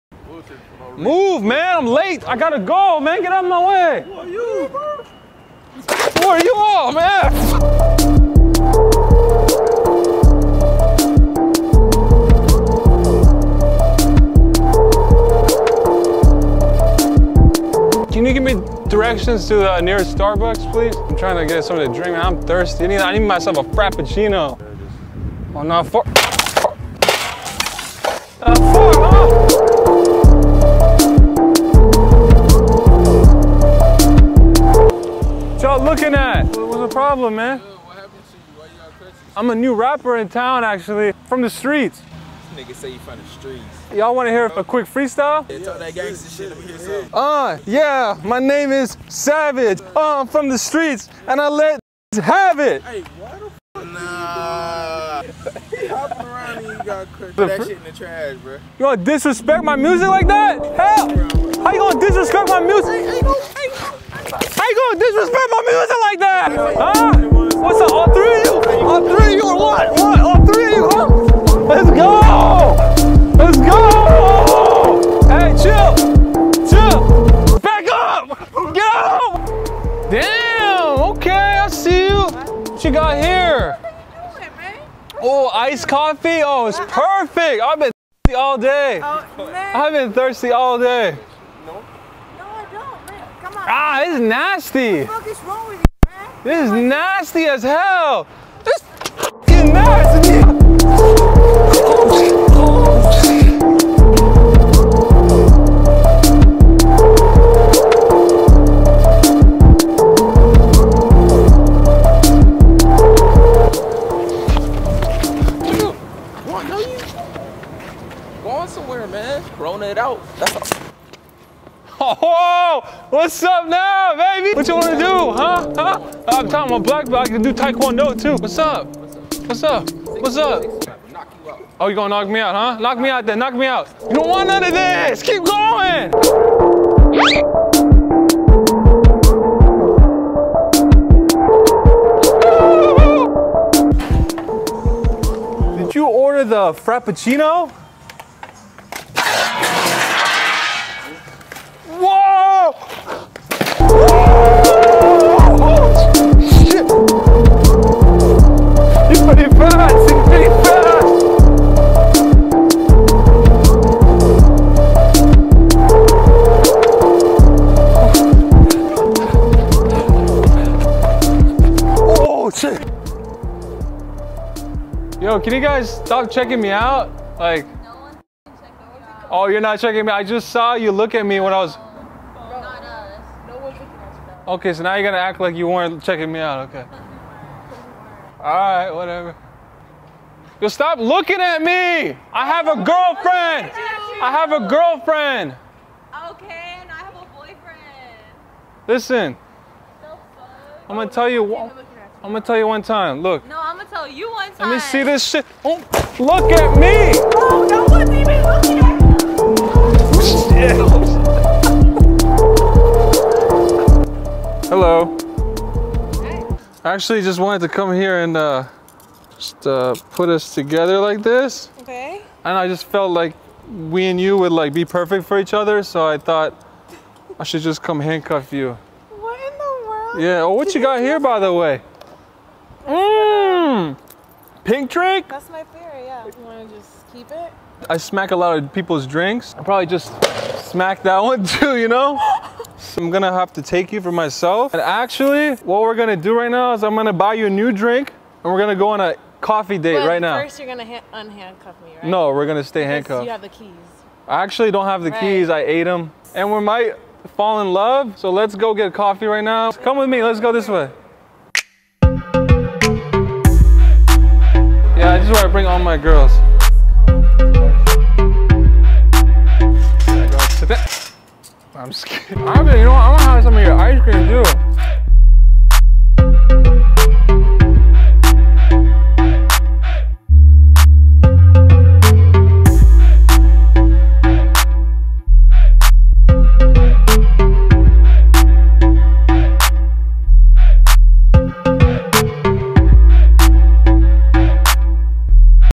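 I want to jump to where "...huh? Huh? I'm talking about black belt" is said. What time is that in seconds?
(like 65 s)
125 s.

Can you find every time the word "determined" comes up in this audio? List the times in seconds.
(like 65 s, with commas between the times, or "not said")
not said.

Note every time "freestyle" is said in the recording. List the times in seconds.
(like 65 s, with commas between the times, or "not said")
44 s.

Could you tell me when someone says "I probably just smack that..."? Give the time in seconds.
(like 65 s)
239 s.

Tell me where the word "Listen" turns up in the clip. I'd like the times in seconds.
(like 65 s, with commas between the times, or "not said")
198 s.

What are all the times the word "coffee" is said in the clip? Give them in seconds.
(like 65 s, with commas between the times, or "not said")
85 s, 249 s, 258 s.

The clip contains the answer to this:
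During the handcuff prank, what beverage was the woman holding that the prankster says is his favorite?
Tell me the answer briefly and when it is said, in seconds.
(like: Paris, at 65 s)
Pink drink, at 234 s.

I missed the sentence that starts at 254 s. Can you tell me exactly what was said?
I actually don't have the right.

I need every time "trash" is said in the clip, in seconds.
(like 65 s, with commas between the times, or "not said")
57 s.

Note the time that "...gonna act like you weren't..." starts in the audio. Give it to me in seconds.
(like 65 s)
185 s.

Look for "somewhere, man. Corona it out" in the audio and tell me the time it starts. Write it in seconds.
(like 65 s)
118 s.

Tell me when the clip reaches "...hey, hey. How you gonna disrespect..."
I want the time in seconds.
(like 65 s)
63 s.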